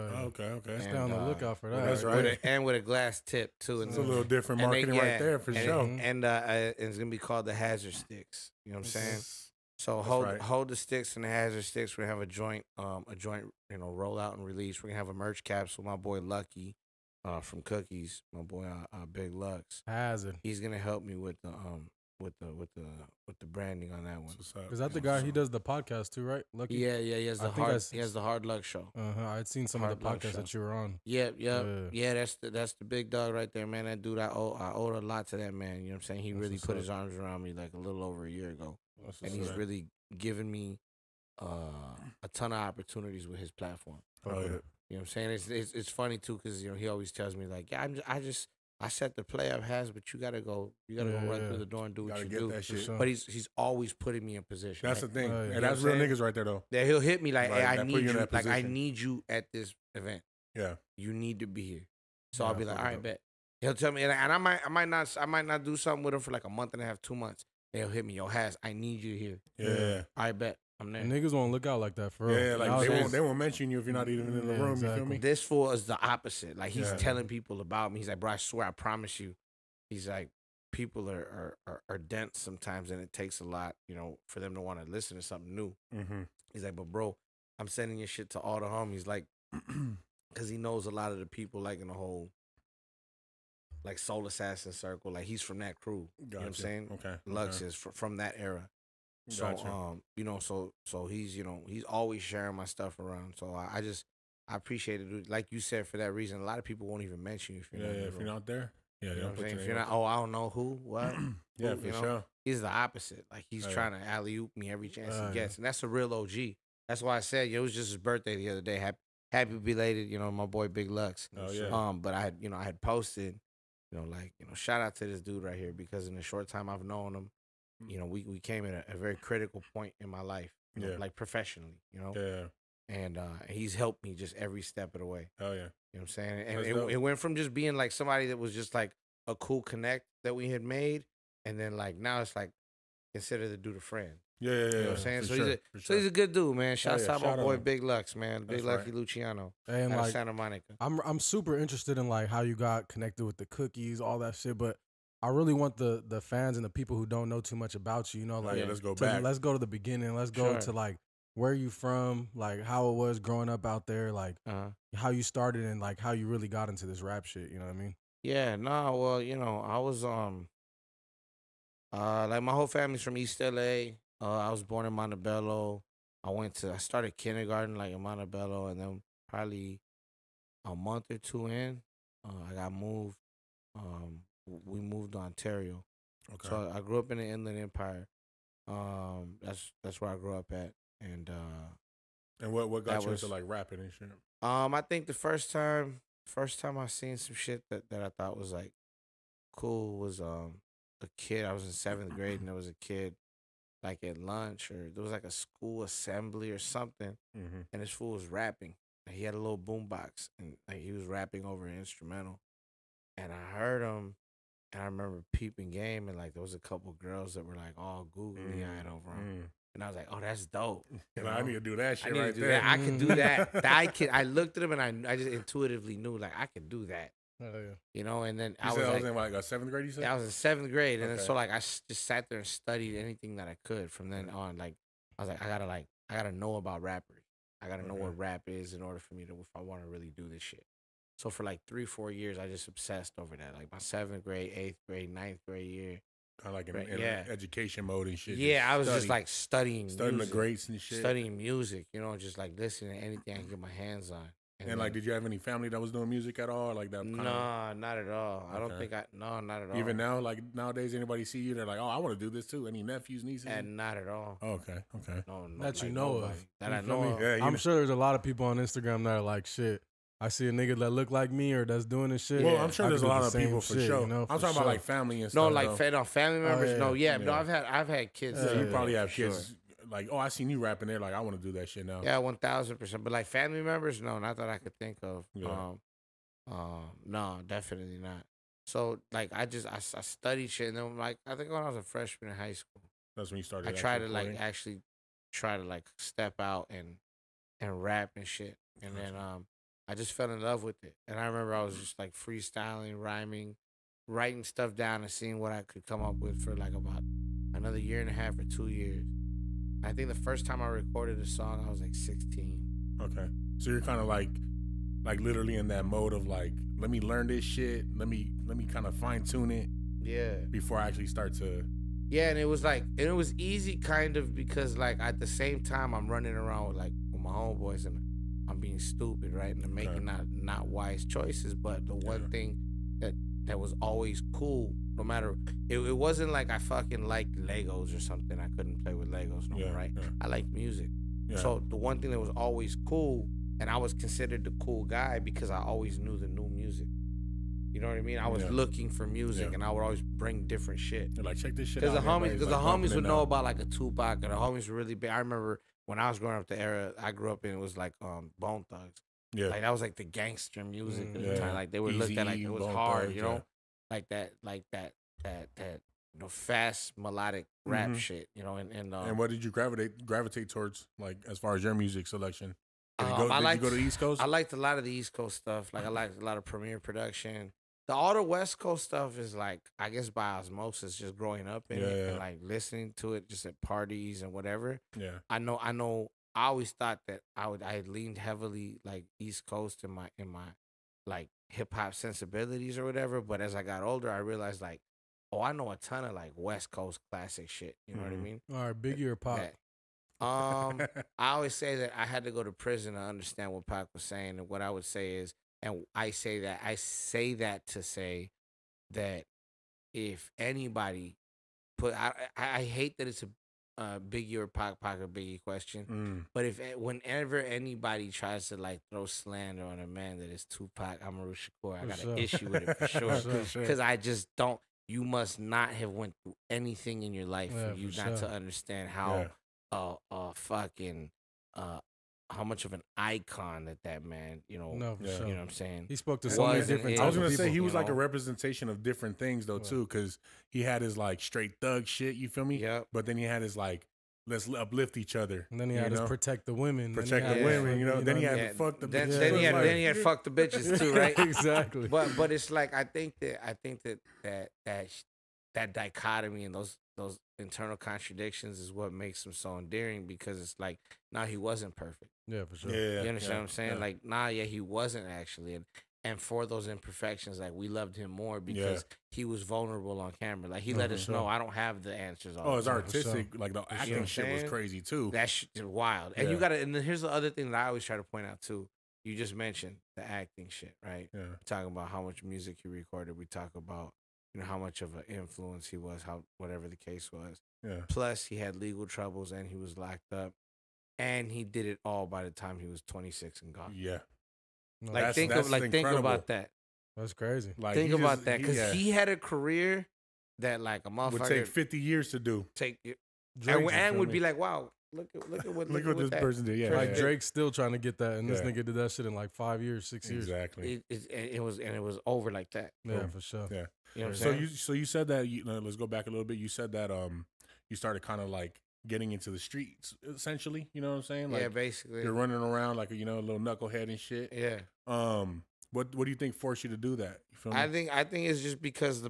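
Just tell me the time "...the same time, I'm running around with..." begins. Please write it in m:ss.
5:25.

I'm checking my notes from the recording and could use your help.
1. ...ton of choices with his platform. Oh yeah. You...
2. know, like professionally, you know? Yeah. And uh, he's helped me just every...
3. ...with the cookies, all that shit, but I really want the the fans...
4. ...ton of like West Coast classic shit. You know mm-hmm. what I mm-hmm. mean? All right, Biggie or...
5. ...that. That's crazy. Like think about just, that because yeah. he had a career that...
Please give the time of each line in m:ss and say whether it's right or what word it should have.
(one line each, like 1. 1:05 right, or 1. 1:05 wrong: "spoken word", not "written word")
1. 0:42 wrong: "opportunities", not "choices"
2. 2:10 right
3. 2:33 right
4. 6:35 right
5. 8:16 right.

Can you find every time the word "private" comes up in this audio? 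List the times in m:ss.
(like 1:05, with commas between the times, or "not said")
not said.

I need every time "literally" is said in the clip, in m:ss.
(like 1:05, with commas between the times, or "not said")
5:15.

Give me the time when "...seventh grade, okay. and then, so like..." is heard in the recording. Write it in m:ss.
3:50.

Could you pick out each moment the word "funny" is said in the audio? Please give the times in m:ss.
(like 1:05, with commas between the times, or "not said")
0:45.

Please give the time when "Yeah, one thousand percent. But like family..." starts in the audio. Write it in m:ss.
4:42.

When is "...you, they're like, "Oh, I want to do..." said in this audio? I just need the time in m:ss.
4:21.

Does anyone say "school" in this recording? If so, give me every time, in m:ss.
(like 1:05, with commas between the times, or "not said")
3:25, 4:52.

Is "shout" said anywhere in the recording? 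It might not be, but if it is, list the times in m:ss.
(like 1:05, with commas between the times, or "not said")
2:04, 2:26.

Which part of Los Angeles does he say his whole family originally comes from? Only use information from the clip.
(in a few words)
East LA.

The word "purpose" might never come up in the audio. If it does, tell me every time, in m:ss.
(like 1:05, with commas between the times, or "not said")
not said.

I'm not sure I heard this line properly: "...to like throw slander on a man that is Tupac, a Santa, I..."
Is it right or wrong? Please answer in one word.
wrong.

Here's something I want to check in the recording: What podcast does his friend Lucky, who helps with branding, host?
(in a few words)
The Hard Luck Show.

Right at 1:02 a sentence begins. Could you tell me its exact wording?
So yeah, I'll be like, all right, up.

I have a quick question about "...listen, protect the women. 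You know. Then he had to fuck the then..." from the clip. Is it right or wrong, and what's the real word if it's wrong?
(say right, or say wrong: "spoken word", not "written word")
wrong: "women", not "listen".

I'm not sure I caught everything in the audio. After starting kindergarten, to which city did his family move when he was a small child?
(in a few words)
Ontario.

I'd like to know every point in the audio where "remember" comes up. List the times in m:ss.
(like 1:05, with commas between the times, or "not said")
3:34, 5:01, 5:55.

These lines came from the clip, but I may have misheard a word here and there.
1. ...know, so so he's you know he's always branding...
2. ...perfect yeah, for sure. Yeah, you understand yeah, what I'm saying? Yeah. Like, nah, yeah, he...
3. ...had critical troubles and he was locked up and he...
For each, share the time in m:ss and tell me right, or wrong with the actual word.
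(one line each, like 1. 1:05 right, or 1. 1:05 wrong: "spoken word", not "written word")
1. 1:40 wrong: "sharing", not "branding"
2. 7:41 right
3. 8:08 wrong: "legal", not "critical".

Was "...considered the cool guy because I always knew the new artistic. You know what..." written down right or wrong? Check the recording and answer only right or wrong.
wrong.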